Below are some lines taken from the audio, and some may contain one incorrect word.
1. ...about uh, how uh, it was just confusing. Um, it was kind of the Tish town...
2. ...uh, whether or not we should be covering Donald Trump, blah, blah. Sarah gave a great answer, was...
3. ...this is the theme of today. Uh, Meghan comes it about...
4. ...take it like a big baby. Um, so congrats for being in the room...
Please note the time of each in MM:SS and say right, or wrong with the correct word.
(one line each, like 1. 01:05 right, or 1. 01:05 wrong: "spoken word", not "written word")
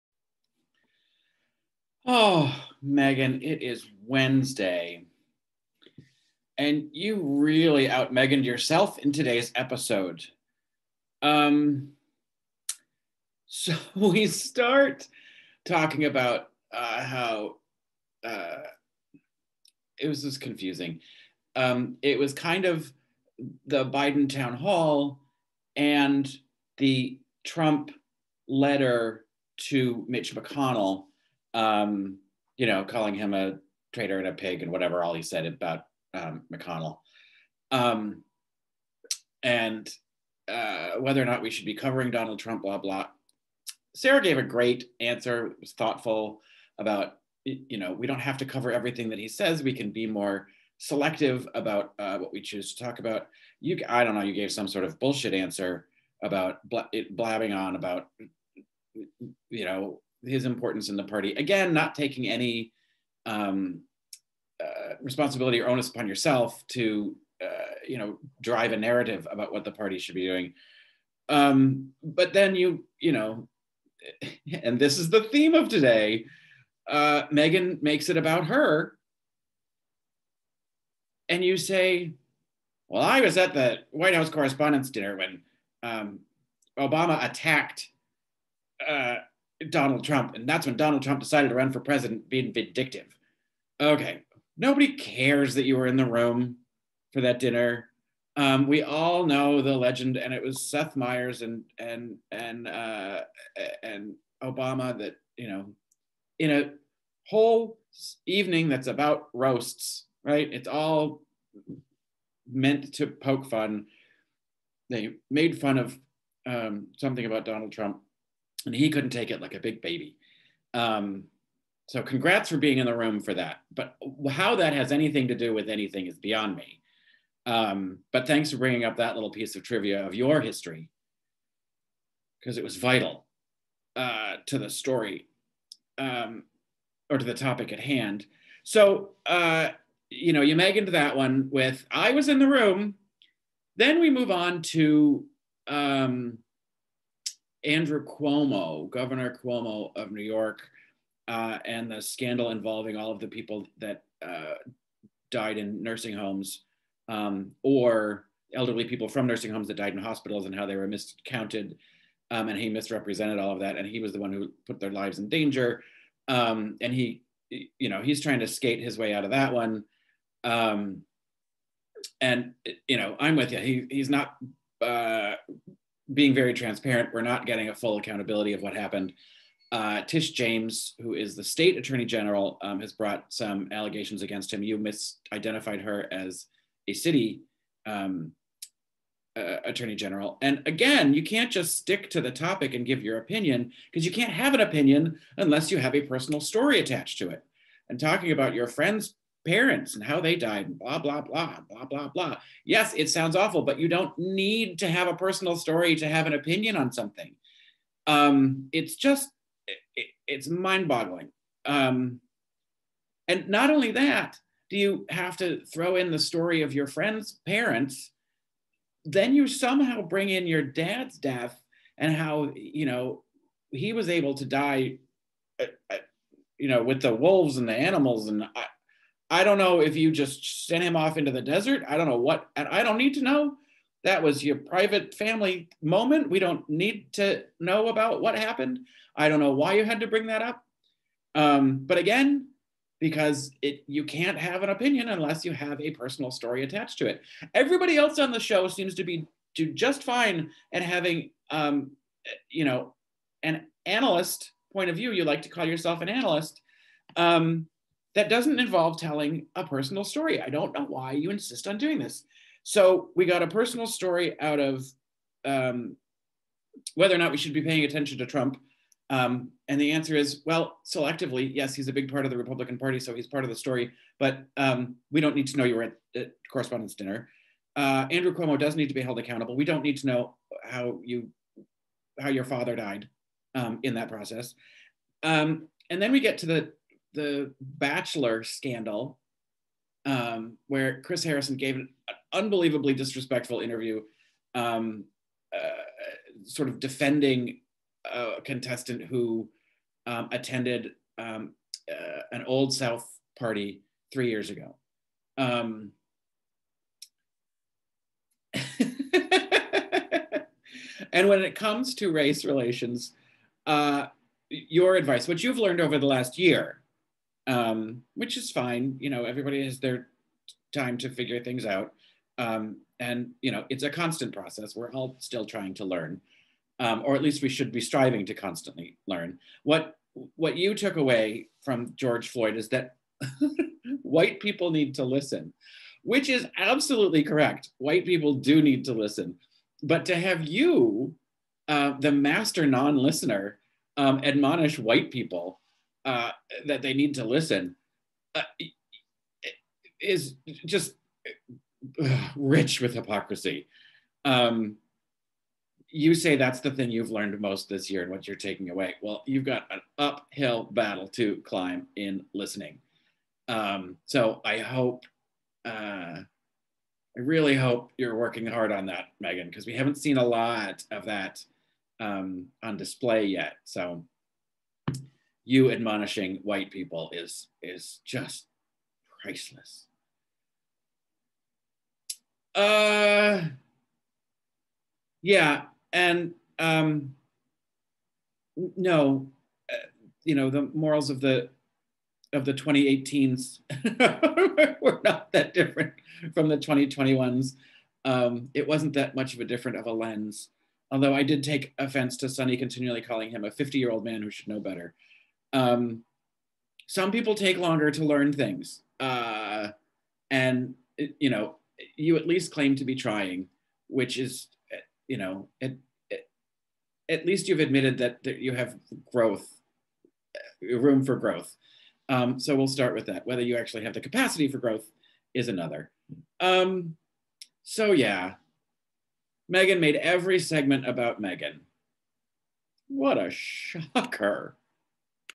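1. 00:16 wrong: "Biden", not "Tish"
2. 00:40 right
3. 01:14 wrong: "makes", not "comes"
4. 01:59 right.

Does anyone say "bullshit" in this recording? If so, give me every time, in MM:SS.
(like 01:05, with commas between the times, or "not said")
00:54.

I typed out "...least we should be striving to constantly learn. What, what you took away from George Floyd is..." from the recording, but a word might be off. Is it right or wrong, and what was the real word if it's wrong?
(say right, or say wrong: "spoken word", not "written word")
right.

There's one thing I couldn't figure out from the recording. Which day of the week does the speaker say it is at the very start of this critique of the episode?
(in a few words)
Wednesday.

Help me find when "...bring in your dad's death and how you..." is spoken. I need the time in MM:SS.
03:40.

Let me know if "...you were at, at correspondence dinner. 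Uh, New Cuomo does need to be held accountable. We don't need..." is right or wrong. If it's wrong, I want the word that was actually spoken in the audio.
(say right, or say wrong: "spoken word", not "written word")
wrong: "Andrew", not "New".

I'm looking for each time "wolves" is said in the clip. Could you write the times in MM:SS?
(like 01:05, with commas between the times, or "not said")
03:47.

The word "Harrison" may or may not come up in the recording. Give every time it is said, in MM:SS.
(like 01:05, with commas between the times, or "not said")
04:51.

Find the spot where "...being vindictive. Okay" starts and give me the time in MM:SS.
01:32.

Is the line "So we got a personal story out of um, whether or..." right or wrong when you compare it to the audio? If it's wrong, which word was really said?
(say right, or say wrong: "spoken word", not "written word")
right.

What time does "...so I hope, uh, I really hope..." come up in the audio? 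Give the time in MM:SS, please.
06:04.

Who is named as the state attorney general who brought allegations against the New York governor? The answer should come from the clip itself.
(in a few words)
Tish James.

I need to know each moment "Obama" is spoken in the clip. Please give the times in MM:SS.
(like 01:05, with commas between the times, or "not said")
01:26, 01:44.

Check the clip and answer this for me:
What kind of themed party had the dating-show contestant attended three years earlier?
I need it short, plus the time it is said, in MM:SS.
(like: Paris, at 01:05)
Old South party, at 05:02.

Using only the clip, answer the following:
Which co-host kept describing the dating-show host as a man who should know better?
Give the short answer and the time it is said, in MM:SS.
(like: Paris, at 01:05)
Sunny, at 06:42.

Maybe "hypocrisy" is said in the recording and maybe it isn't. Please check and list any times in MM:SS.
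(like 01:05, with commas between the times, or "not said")
05:52.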